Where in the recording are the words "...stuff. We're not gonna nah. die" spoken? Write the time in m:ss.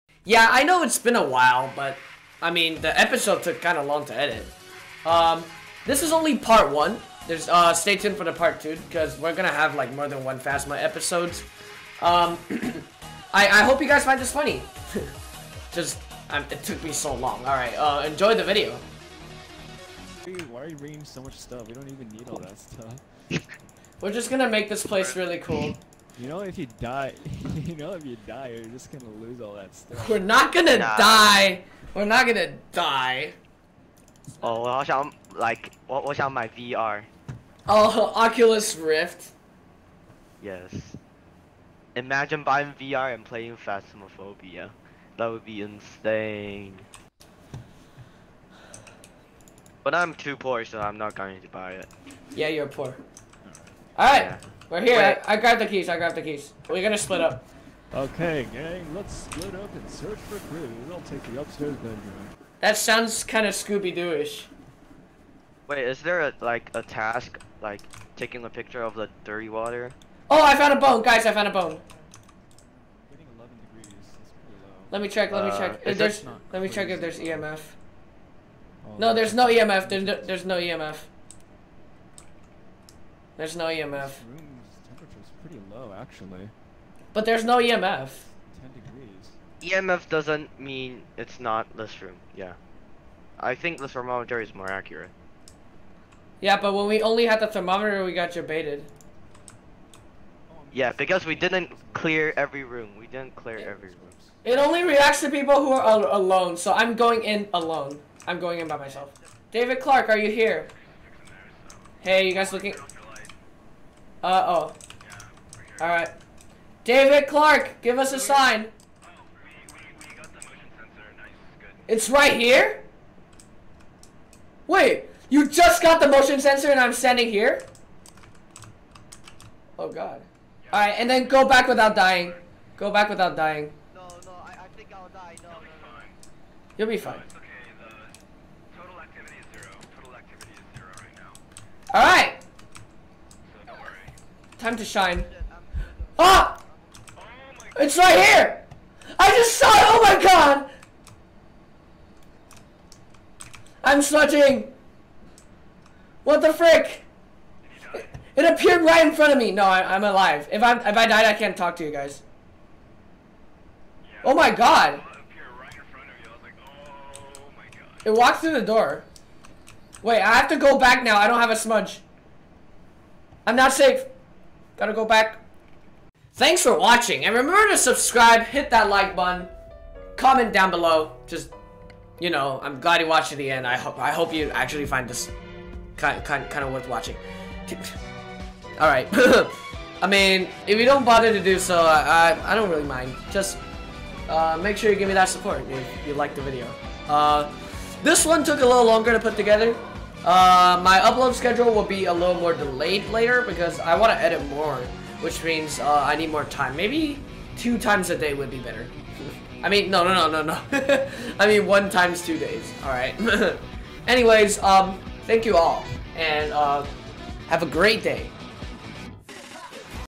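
0:29.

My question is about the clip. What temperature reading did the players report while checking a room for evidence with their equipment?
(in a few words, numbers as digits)
10 degrees.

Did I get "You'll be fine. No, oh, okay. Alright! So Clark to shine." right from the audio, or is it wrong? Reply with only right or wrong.
wrong.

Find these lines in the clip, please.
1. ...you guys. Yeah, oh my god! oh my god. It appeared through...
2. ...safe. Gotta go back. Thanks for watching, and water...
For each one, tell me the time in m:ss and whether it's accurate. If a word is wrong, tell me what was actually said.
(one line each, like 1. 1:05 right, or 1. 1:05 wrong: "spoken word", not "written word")
1. 2:41 wrong: "walked", not "appeared"
2. 2:53 wrong: "remember", not "water".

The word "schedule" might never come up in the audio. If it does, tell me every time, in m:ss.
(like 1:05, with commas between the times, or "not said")
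3:21.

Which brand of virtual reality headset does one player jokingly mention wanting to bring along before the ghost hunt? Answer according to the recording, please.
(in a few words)
Oculus Rift.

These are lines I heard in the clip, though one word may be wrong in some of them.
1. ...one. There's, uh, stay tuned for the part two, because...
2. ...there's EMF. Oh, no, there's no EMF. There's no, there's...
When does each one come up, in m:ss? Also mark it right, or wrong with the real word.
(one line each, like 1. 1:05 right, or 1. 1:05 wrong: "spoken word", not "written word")
1. 0:06 right
2. 1:17 right.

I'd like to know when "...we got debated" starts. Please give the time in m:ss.
1:38.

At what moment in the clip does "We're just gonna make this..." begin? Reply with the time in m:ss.
0:24.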